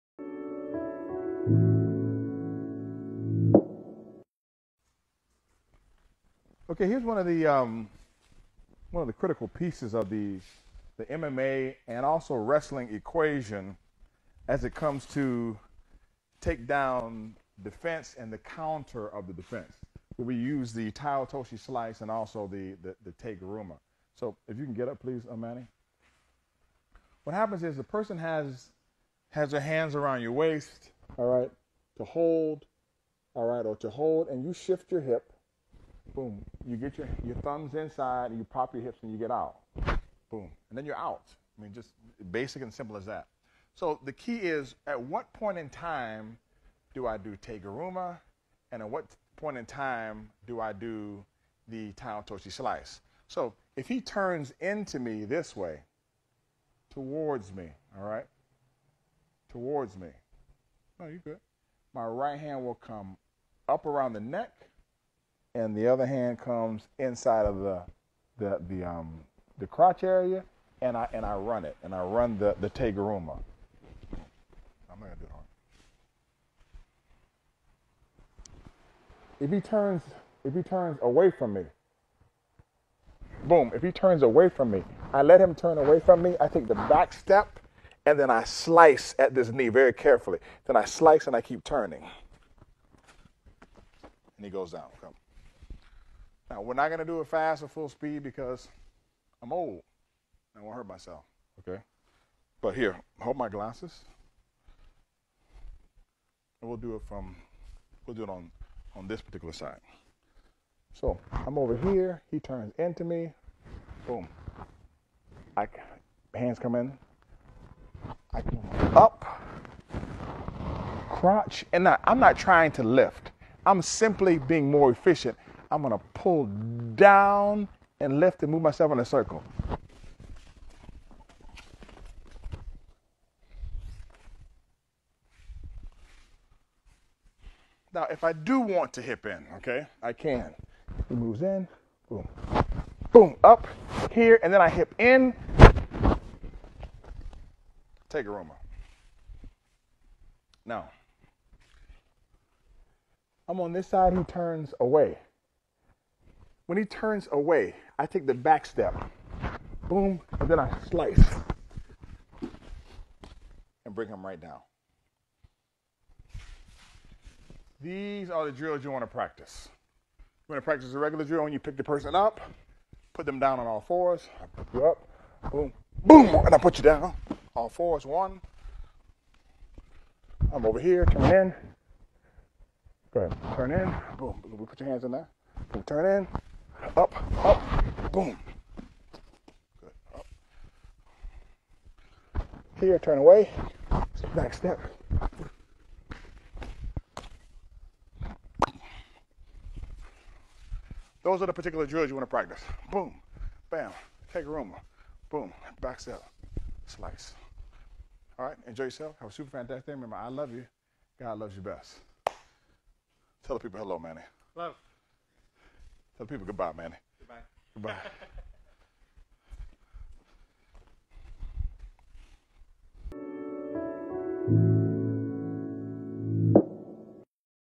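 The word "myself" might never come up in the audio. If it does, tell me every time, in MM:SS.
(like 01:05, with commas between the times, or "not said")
01:40, 02:08.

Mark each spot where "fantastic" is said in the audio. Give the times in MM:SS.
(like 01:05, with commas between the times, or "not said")
03:29.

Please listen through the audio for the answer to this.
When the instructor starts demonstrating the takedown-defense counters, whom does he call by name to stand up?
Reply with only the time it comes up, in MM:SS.
00:25.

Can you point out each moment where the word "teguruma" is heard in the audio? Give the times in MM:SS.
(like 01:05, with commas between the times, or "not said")
00:23, 00:47, 01:12, 02:28, 03:24.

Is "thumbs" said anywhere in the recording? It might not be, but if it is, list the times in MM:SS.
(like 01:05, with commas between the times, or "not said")
00:37.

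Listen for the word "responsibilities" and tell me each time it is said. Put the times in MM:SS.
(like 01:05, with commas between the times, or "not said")
not said.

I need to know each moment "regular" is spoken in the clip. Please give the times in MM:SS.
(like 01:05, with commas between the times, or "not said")
02:50.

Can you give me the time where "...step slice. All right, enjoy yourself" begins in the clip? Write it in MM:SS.
03:25.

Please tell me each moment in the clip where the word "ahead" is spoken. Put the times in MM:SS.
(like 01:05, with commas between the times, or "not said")
03:03.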